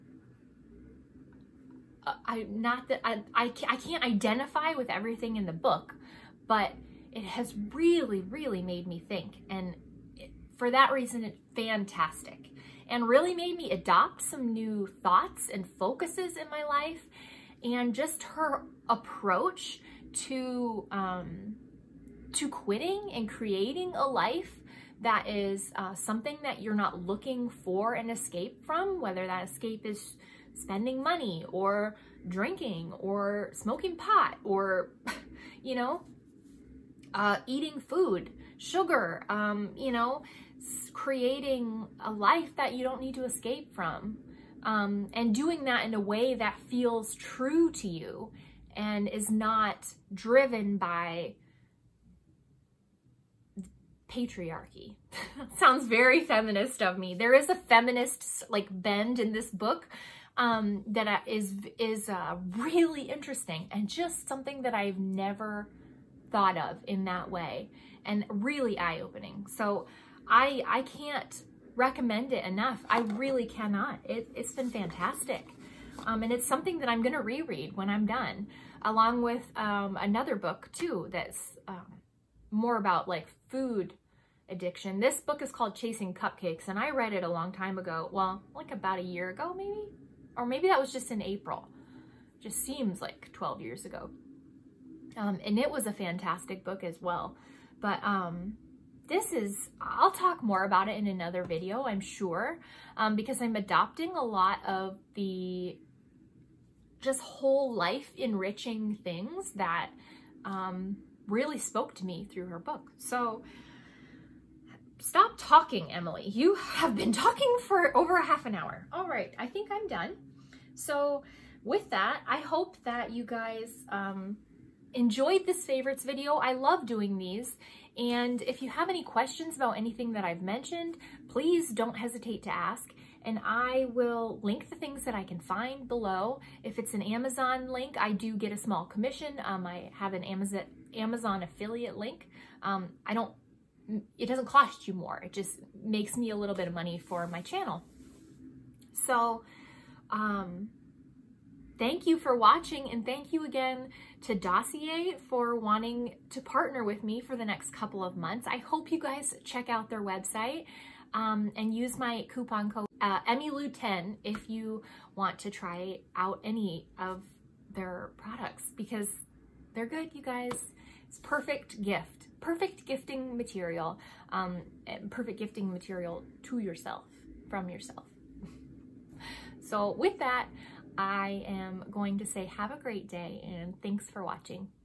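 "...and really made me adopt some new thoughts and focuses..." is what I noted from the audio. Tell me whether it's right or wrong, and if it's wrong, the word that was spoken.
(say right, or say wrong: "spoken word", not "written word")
right.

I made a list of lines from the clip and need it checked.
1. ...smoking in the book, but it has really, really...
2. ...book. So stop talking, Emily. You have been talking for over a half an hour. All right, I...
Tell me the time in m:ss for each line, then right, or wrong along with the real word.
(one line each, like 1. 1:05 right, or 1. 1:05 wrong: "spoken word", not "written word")
1. 0:04 wrong: "everything", not "smoking"
2. 1:52 right.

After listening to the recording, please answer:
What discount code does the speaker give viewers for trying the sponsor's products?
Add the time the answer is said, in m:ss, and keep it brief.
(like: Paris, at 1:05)
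EmiLou10, at 2:43.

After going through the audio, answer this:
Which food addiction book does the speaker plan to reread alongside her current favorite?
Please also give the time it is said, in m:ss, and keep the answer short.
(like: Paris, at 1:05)
Chasing Cupcakes, at 1:25.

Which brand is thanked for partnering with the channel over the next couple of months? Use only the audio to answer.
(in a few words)
Dossier.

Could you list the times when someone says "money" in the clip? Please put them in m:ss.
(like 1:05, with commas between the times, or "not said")
0:31, 2:26.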